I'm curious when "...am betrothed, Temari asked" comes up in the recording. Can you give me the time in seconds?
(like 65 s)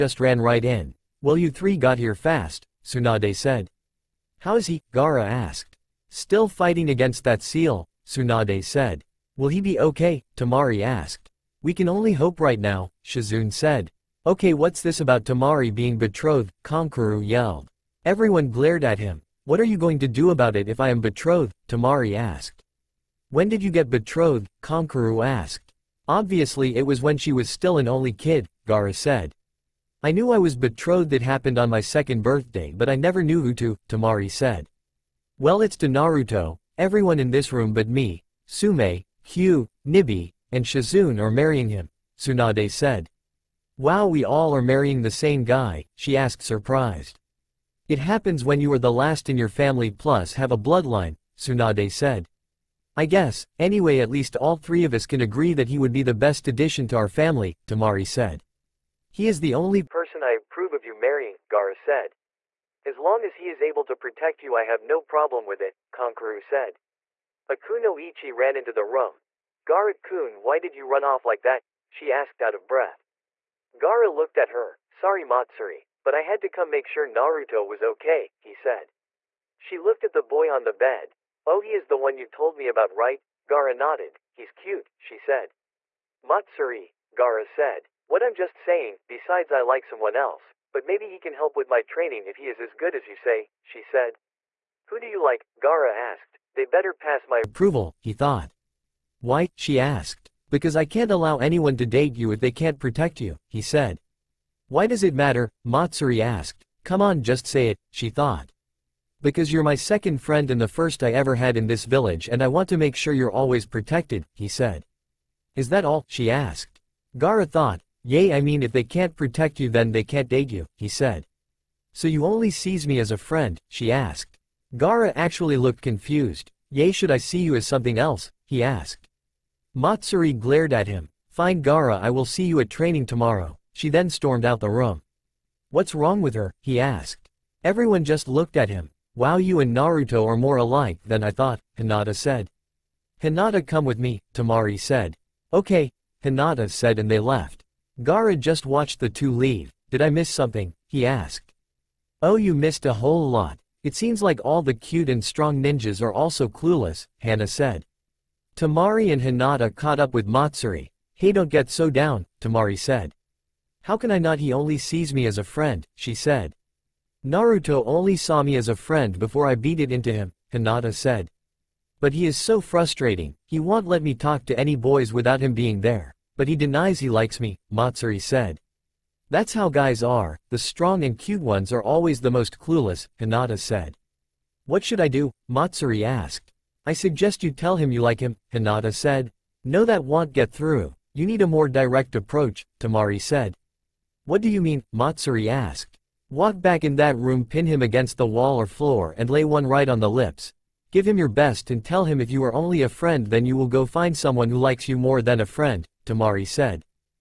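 20 s.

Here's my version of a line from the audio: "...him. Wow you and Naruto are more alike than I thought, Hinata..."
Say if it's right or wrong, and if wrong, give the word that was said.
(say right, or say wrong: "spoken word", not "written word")
right.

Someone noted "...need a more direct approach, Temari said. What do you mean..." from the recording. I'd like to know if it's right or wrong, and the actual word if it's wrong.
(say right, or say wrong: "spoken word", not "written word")
right.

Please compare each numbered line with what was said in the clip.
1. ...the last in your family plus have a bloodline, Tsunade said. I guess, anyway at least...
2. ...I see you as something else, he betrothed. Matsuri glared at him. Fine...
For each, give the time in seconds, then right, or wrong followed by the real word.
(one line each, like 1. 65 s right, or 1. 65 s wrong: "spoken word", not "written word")
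1. 48 s right
2. 127 s wrong: "asked", not "betrothed".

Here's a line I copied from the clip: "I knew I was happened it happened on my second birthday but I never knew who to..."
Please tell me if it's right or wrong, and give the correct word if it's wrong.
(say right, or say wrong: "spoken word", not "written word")
wrong: "betrothed", not "happened".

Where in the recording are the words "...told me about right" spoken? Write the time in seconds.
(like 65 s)
82 s.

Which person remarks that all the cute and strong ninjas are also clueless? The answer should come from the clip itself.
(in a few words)
Hana.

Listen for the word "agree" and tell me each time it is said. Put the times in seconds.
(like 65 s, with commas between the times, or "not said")
55 s.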